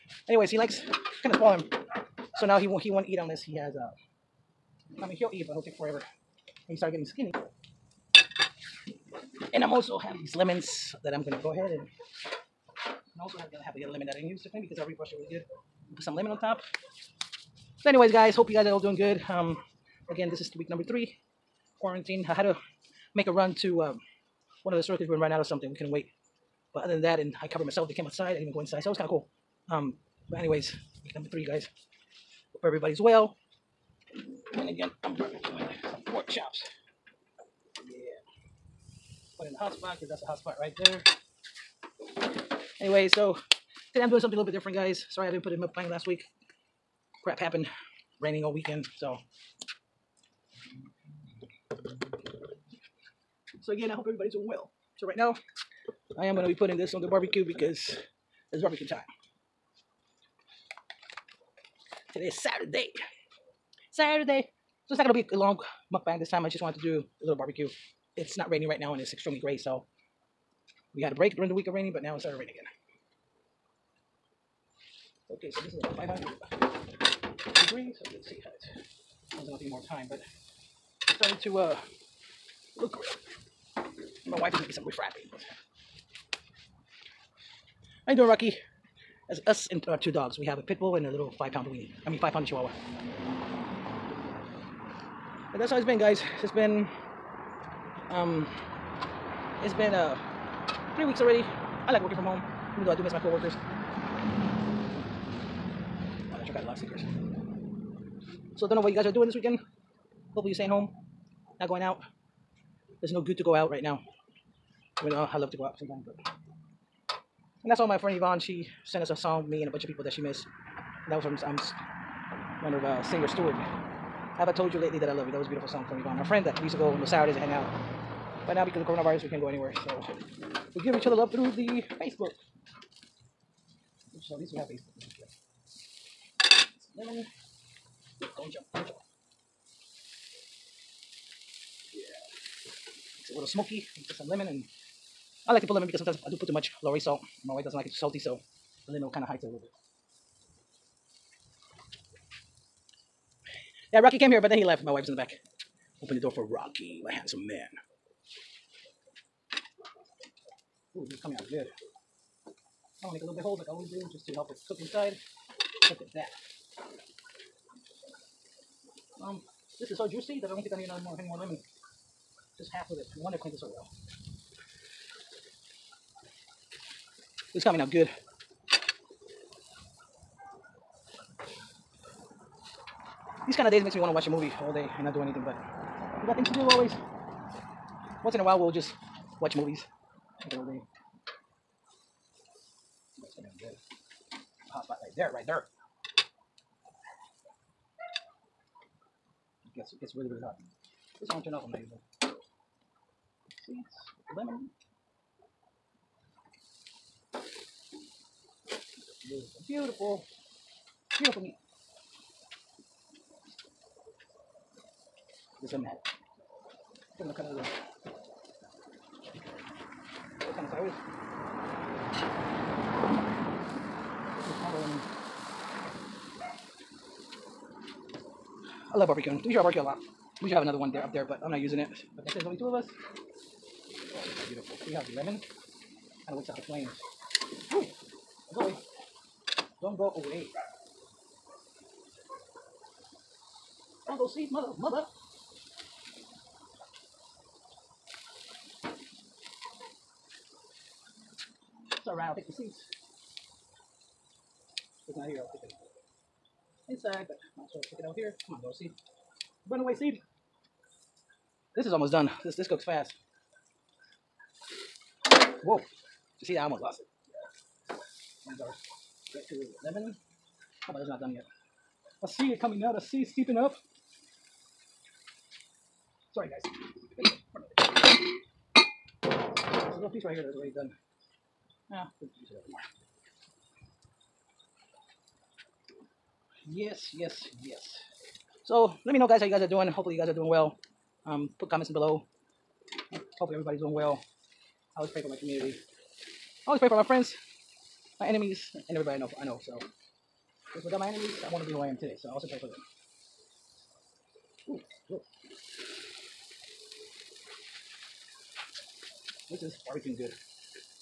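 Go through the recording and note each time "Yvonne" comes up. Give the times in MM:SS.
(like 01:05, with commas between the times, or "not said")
01:58, 02:06.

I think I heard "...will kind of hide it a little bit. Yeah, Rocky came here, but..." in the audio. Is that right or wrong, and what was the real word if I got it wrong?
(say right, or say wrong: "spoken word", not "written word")
right.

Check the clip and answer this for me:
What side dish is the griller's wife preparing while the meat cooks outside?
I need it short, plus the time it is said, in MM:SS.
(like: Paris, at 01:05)
Beans, at 01:24.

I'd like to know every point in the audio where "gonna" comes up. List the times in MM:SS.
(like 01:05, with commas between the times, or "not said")
00:11, 02:43, 03:13, 03:37.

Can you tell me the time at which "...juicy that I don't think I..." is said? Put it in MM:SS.
02:50.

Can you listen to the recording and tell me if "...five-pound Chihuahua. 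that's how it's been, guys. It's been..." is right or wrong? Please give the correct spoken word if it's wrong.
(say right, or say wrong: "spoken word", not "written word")
right.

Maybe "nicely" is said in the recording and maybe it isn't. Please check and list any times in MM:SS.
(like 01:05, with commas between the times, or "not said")
not said.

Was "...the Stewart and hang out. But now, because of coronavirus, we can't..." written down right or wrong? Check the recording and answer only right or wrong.
wrong.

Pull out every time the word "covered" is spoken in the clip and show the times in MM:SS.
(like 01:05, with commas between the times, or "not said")
00:27.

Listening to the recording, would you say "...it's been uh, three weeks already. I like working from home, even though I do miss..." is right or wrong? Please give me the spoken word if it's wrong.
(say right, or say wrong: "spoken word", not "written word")
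right.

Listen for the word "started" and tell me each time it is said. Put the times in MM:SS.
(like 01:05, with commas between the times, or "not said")
00:06, 01:12, 01:21.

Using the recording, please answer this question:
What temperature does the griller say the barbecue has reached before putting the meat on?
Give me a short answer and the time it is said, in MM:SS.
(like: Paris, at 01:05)
500 degrees, at 01:15.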